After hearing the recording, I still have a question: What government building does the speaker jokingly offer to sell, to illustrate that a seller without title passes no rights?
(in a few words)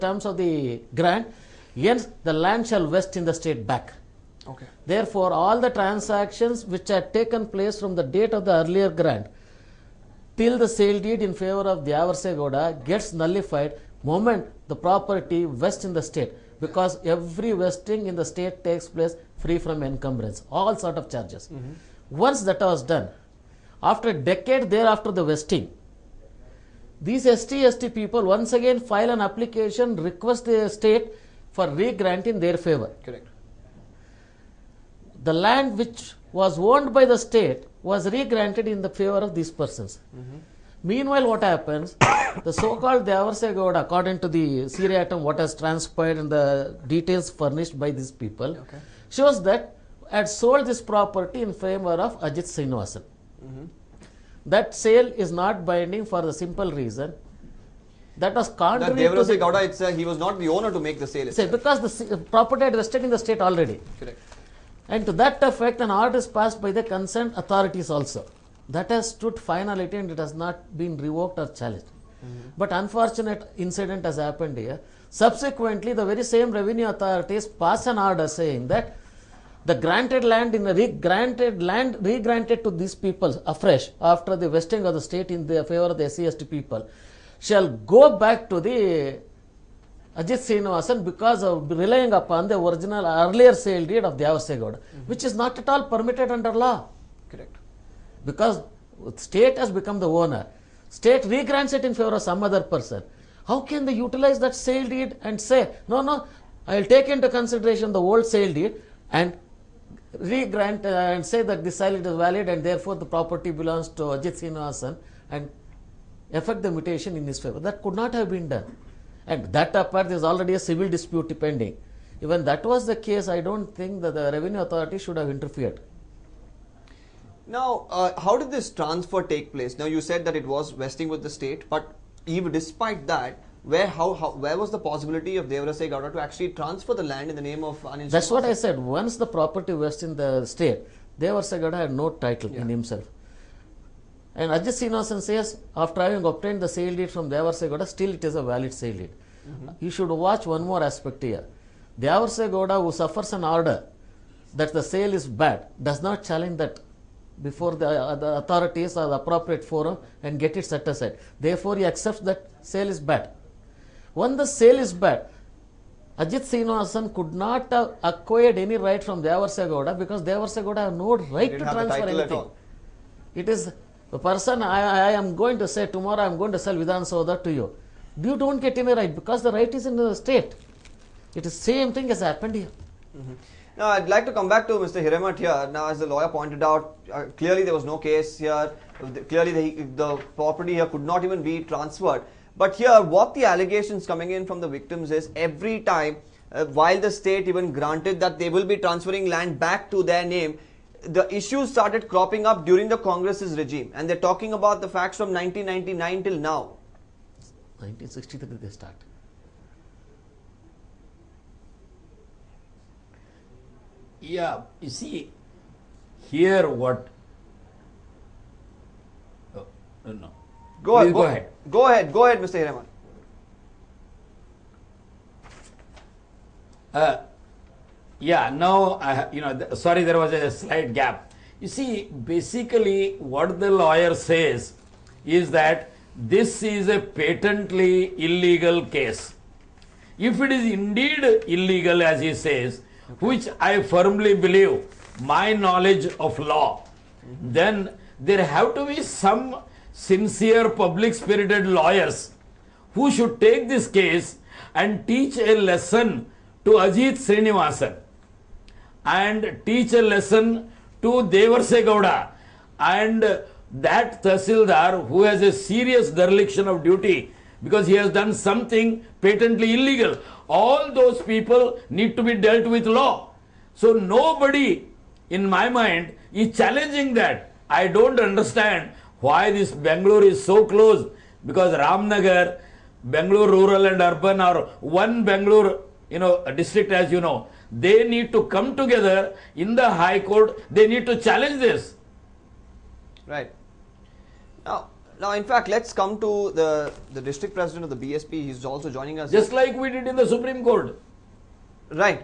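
Vidhan Soudha.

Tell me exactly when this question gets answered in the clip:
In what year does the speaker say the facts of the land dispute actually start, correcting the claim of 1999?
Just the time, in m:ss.
3:27.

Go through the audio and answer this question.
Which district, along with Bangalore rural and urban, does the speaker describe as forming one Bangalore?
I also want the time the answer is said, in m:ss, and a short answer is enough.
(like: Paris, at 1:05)
Ramnagar, at 4:41.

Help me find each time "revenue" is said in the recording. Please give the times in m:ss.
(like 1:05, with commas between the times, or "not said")
1:16, 2:04.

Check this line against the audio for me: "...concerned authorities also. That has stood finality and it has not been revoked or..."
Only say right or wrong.
right.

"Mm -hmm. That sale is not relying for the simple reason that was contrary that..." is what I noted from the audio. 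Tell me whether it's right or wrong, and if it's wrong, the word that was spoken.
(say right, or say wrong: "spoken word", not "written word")
wrong: "binding", not "relying".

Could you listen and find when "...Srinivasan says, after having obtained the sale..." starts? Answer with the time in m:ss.
2:24.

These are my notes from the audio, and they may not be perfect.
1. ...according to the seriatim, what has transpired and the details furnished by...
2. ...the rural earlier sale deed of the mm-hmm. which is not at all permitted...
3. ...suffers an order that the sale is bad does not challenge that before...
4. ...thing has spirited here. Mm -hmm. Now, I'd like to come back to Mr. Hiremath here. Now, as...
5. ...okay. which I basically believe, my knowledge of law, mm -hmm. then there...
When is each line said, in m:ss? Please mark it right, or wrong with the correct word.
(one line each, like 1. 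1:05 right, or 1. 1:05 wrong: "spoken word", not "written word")
1. 0:43 right
2. 1:32 wrong: "original", not "rural"
3. 2:32 right
4. 3:01 wrong: "happened", not "spirited"
5. 4:03 wrong: "firmly", not "basically".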